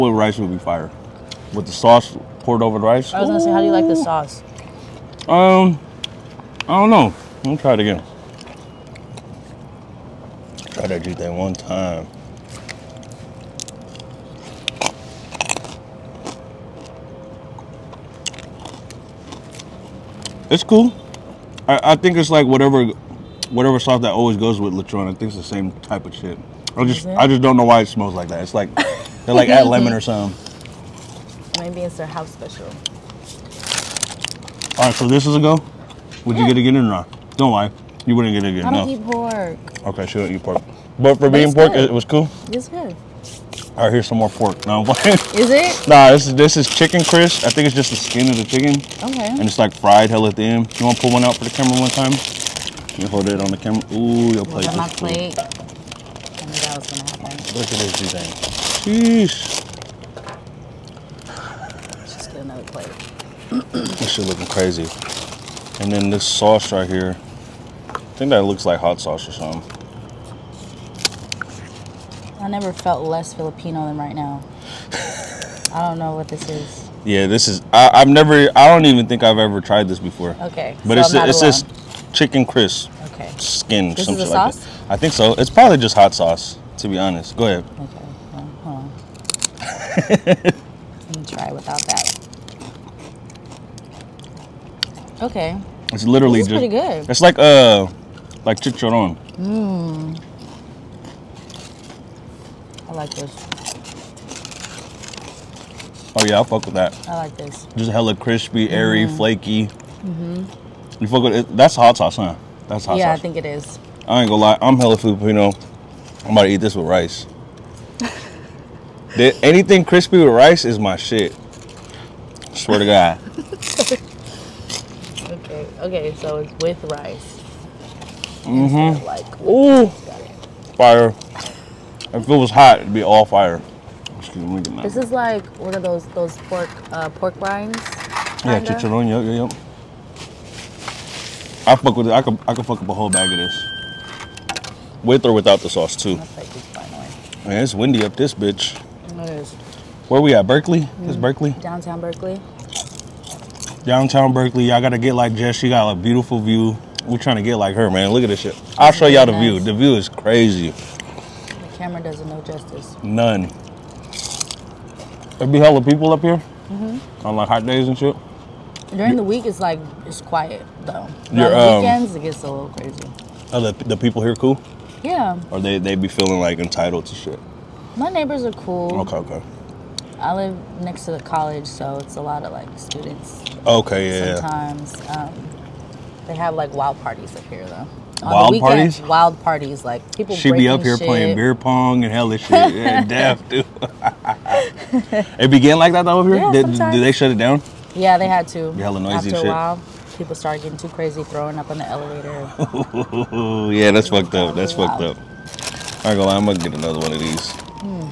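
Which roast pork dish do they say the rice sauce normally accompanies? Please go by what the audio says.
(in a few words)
lechon.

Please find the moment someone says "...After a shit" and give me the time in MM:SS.
03:19.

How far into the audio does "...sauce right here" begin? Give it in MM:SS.
01:06.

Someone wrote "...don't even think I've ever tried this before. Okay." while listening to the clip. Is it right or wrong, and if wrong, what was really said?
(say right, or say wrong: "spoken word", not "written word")
right.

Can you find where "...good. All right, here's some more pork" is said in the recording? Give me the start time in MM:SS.
00:42.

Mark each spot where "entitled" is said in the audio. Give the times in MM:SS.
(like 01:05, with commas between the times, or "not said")
02:56.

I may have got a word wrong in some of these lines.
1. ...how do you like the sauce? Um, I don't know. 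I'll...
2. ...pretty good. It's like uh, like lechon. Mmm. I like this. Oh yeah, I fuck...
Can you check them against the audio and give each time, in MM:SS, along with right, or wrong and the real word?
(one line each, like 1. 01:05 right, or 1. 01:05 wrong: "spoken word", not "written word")
1. 00:03 right
2. 01:36 wrong: "chicharron", not "lechon".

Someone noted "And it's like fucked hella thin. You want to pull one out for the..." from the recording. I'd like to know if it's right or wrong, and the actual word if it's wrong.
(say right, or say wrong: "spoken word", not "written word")
wrong: "fried", not "fucked".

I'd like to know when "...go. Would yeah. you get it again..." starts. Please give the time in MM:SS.
00:35.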